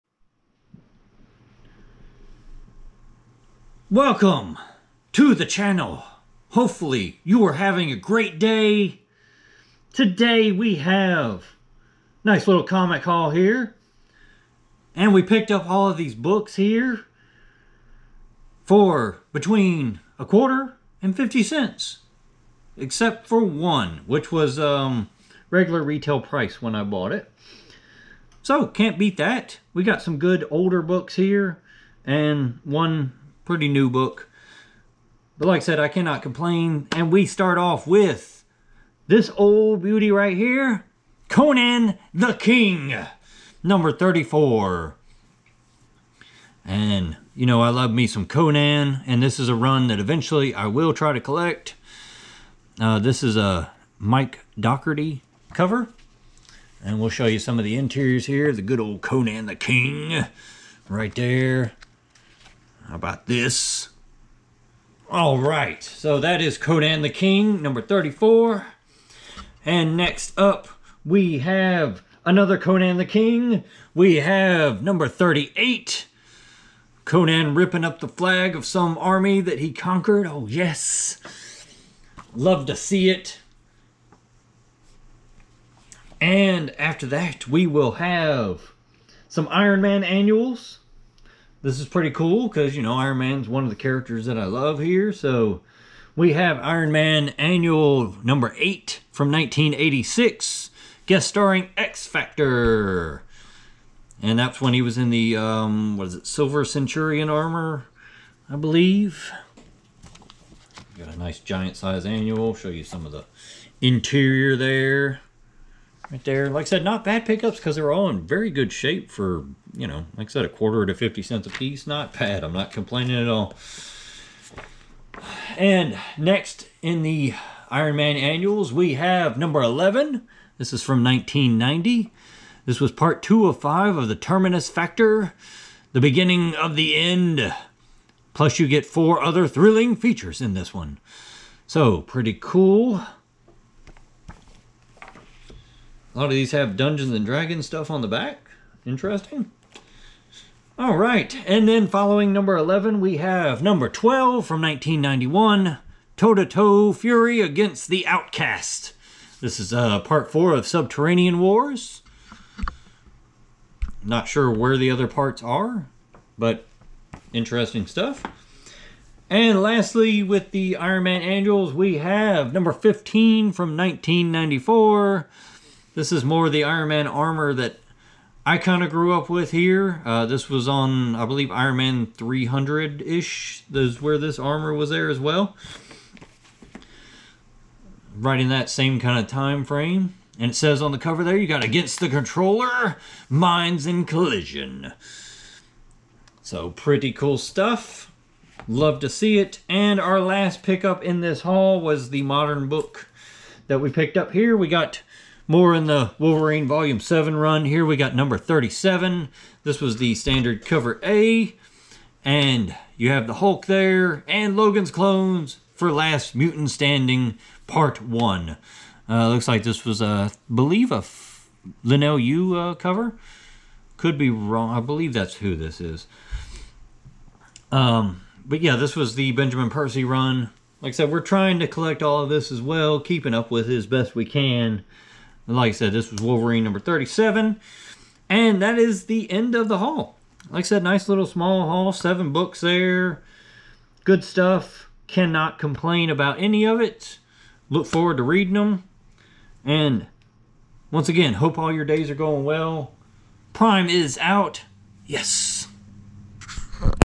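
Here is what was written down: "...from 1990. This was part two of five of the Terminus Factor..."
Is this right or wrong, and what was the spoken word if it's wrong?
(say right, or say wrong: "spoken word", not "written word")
right.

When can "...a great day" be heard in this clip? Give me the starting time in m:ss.
0:07.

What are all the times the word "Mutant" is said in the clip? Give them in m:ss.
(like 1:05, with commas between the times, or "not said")
3:36.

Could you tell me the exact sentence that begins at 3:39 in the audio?
Uh, looks like this was, a uh, I believe, a Leinil Yu uh, cover.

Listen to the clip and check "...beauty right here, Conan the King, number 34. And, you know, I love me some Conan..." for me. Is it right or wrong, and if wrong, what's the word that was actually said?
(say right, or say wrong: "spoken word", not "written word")
right.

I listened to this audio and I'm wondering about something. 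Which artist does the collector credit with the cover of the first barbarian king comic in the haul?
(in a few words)
Mike Docherty.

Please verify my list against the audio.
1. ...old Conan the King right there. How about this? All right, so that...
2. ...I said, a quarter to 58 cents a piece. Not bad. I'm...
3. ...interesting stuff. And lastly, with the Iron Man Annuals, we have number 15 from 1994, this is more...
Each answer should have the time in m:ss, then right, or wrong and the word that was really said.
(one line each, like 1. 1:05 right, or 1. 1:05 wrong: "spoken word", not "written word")
1. 0:58 right
2. 2:00 wrong: "50", not "58"
3. 2:47 right.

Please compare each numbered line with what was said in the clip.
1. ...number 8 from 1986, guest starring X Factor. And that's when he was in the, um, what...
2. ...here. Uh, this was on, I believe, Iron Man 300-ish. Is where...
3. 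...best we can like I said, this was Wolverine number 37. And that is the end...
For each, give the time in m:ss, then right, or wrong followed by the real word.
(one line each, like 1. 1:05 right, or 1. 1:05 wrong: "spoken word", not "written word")
1. 1:38 right
2. 2:59 right
3. 3:53 right.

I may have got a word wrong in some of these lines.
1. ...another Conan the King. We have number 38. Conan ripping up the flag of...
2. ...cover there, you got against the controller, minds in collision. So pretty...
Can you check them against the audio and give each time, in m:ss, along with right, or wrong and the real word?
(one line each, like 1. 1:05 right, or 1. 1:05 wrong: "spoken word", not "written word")
1. 1:12 right
2. 3:10 right.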